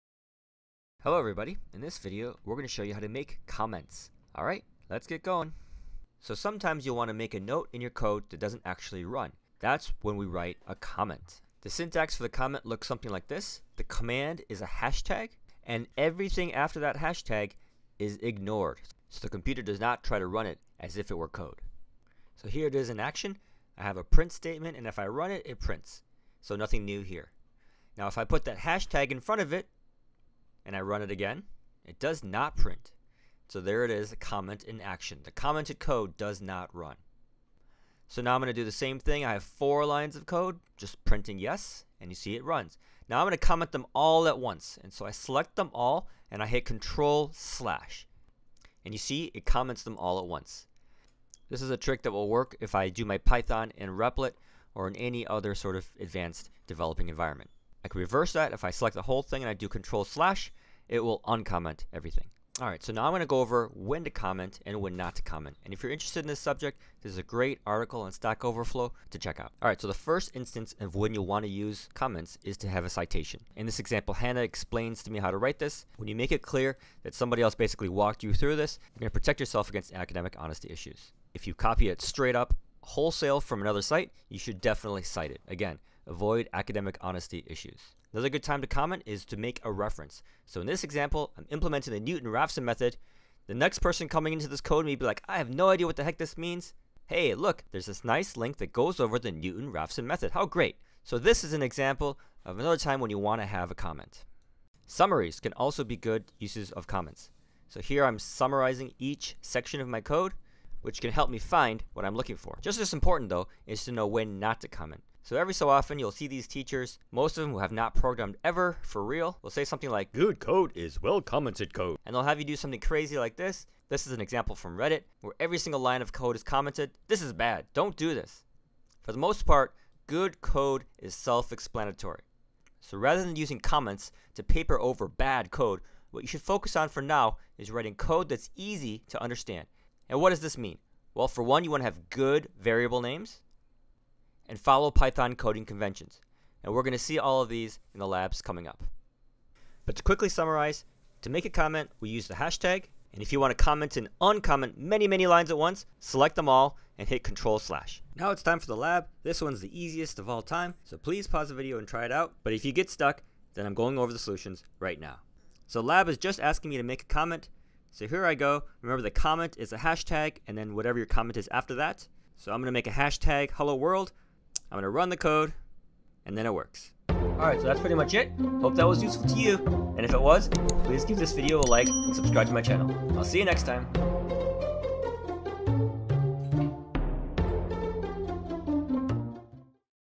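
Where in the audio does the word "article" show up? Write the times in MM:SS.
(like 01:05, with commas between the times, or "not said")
01:07.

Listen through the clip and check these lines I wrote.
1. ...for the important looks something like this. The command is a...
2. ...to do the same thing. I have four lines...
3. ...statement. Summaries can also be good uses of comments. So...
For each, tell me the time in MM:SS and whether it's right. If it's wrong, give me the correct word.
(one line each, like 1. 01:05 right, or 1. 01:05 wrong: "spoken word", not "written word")
1. 00:12 wrong: "comment", not "important"
2. 00:38 right
3. 01:43 wrong: "comment", not "statement".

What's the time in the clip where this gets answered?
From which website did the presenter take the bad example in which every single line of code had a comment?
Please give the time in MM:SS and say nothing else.
02:04.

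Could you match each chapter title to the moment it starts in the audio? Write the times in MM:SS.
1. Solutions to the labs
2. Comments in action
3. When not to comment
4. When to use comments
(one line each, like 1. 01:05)
1. 02:39
2. 00:20
3. 01:52
4. 01:00.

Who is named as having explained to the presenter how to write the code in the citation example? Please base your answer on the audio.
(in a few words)
Hannah.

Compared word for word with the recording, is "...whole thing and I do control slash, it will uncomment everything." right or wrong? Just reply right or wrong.
right.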